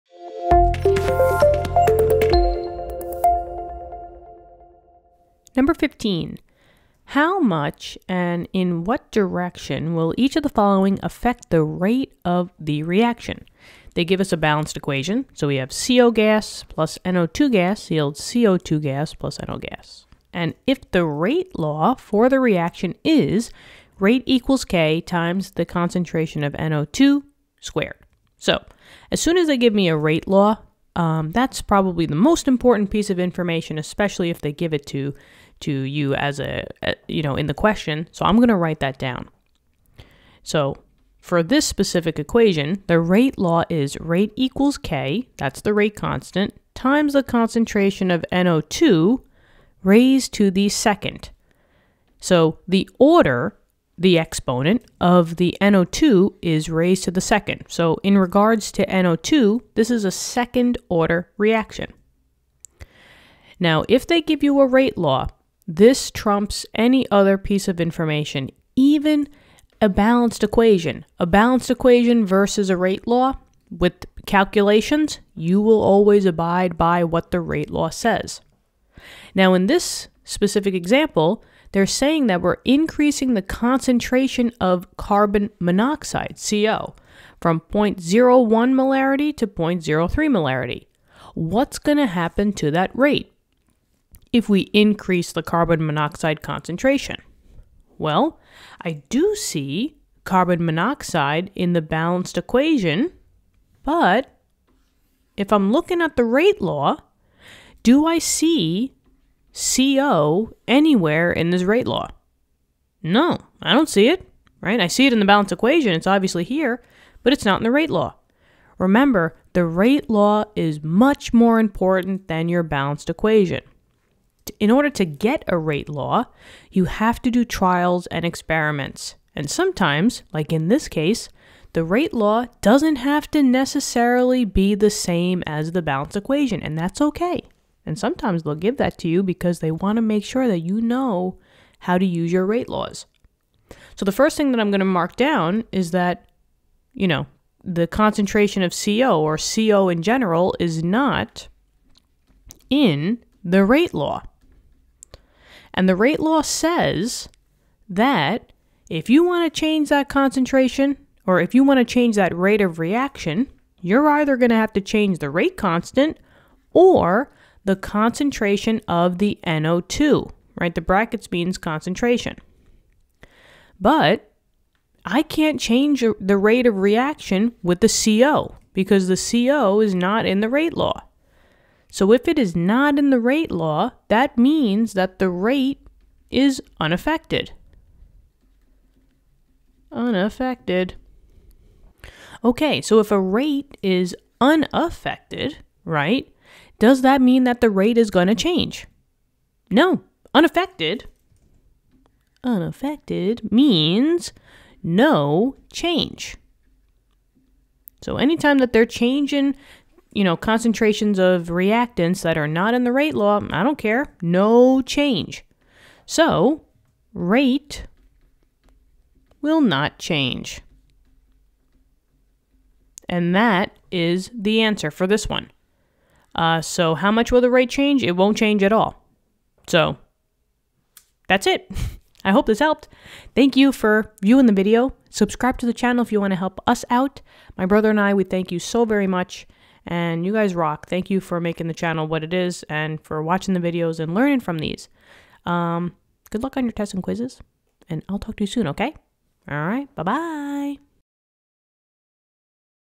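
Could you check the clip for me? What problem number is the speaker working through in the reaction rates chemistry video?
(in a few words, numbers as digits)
15.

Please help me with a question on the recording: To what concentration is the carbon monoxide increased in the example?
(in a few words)
0.03 M.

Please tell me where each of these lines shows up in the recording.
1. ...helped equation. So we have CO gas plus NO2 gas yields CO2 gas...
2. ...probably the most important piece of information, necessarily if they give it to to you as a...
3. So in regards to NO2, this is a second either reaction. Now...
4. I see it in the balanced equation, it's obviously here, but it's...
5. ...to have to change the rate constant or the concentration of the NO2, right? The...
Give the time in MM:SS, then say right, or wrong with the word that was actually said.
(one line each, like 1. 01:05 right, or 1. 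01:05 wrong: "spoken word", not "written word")
1. 00:14 wrong: "balanced", not "helped"
2. 00:31 wrong: "especially", not "necessarily"
3. 00:57 wrong: "order", not "either"
4. 01:54 right
5. 02:44 right.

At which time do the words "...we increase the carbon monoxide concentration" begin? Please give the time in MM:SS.
01:34.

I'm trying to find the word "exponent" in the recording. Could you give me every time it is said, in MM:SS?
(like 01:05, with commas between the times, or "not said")
00:54.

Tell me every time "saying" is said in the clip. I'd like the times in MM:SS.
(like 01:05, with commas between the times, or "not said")
01:21.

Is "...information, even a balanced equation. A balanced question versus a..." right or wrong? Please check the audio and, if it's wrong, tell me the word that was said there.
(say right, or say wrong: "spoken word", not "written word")
wrong: "equation", not "question".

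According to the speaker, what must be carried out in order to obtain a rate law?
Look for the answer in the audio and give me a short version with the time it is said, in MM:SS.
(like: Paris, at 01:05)
Trials and experiments, at 02:07.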